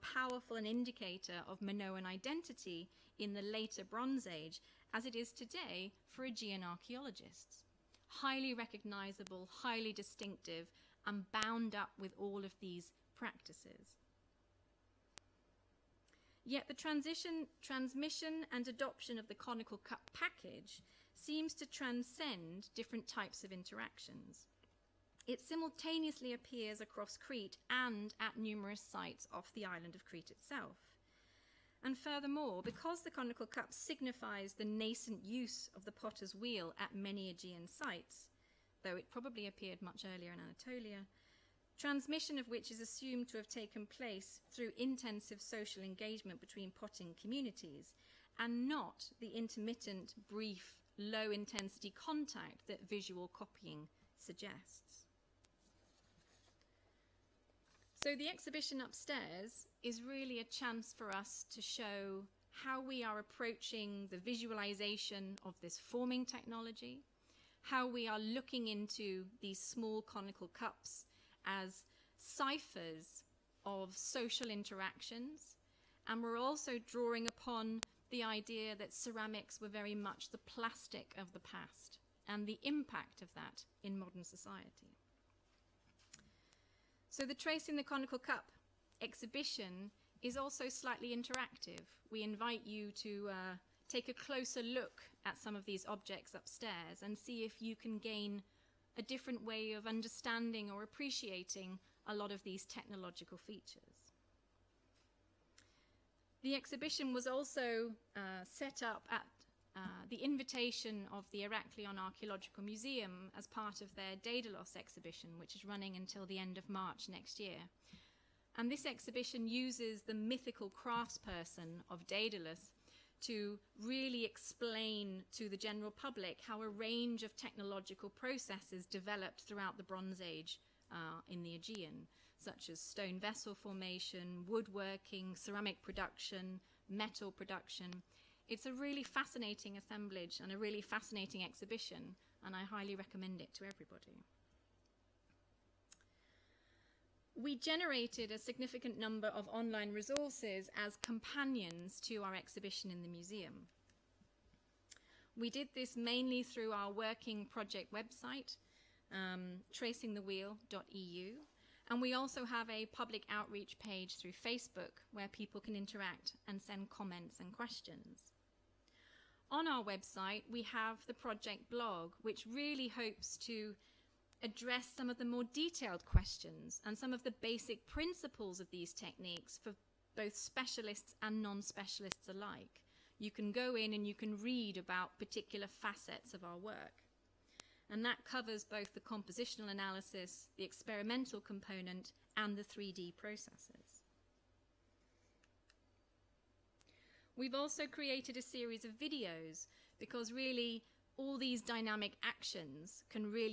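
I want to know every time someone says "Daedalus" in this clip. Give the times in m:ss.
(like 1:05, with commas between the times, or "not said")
1:54, 2:02.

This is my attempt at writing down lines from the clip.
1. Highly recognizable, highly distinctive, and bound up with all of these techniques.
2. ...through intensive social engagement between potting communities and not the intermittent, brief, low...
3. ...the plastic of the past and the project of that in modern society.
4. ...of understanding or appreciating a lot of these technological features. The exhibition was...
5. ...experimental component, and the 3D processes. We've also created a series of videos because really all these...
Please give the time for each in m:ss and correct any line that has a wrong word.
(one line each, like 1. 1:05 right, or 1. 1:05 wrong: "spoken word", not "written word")
1. 0:08 wrong: "practices", not "techniques"
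2. 0:44 right
3. 1:20 wrong: "impact", not "project"
4. 1:39 right
5. 3:10 right.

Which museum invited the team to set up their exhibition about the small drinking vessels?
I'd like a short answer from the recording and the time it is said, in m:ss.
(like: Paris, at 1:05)
Heraklion Archaeological Museum, at 1:51.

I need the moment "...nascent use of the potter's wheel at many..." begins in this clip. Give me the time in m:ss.
0:34.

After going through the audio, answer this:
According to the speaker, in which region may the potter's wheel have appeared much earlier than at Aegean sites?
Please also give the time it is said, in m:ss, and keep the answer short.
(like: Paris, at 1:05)
Anatolia, at 0:40.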